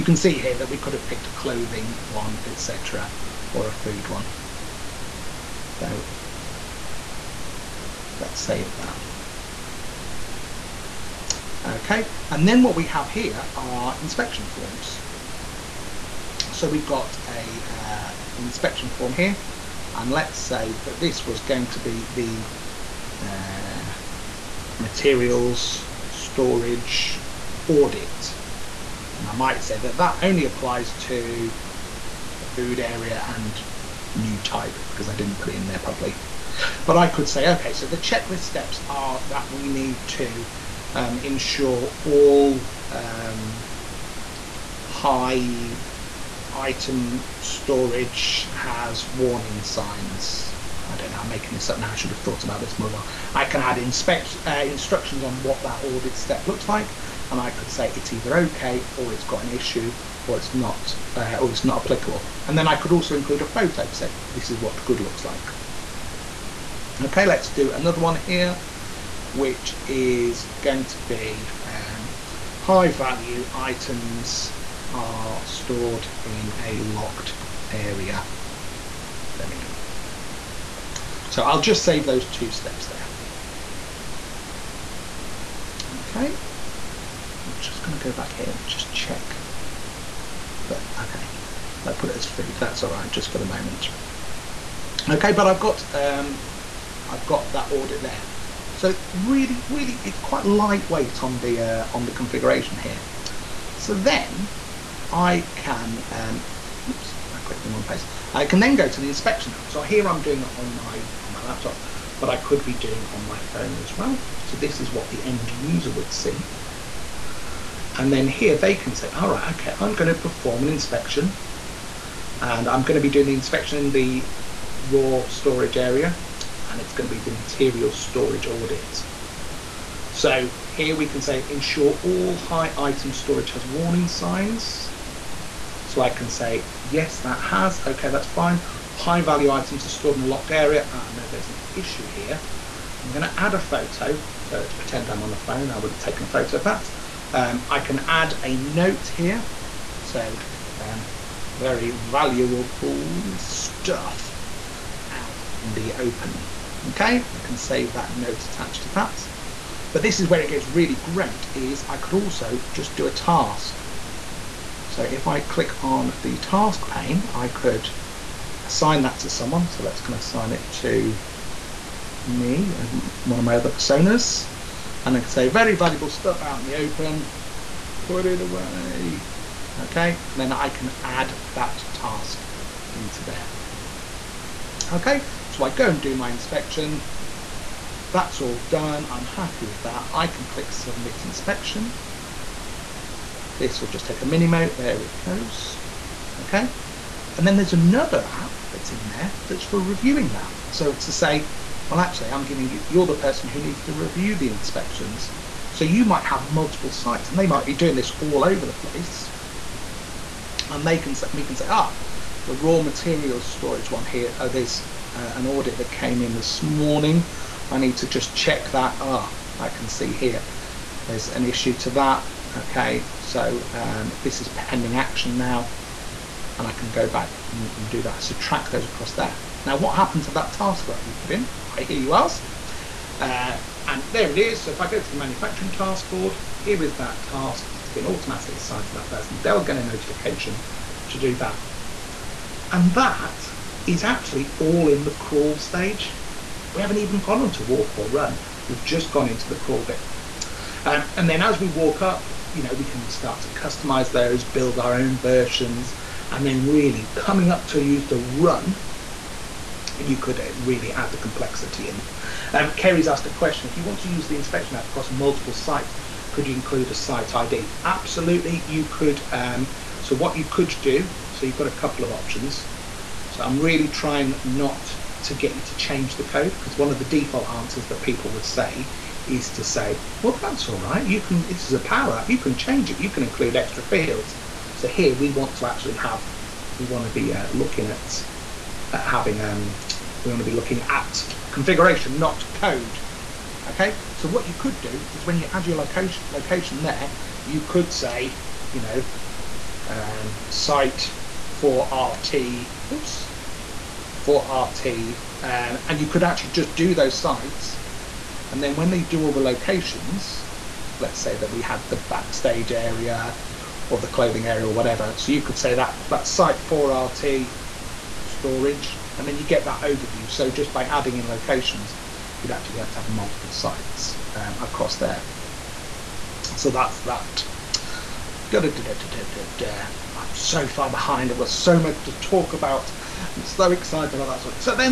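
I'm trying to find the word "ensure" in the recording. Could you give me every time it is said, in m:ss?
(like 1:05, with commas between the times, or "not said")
0:41, 2:11.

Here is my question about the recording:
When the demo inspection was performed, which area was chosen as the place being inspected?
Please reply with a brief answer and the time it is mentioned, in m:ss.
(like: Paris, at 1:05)
raw storage area, at 2:04.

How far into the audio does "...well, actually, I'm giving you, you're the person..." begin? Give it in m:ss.
3:21.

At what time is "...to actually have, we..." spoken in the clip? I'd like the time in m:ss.
4:45.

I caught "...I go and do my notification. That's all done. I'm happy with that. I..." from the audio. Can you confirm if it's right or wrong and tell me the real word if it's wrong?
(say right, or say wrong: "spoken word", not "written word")
wrong: "inspection", not "notification".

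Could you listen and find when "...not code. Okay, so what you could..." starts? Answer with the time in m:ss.
4:52.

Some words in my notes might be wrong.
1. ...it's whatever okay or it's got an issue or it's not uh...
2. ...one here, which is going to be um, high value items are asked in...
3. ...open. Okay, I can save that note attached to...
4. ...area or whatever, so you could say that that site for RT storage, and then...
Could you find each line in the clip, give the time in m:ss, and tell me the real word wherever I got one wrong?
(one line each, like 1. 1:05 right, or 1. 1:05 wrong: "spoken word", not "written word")
1. 0:57 wrong: "either", not "whatever"
2. 1:07 wrong: "stored", not "asked"
3. 2:35 right
4. 5:14 right.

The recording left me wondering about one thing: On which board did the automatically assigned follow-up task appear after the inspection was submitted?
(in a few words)
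manufacturing task board.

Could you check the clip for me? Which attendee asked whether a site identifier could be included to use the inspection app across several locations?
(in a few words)
Kerry.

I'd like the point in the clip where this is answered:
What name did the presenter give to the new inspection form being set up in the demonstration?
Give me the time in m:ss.
0:24.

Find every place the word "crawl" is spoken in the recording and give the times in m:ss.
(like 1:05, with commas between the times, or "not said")
4:05, 4:09.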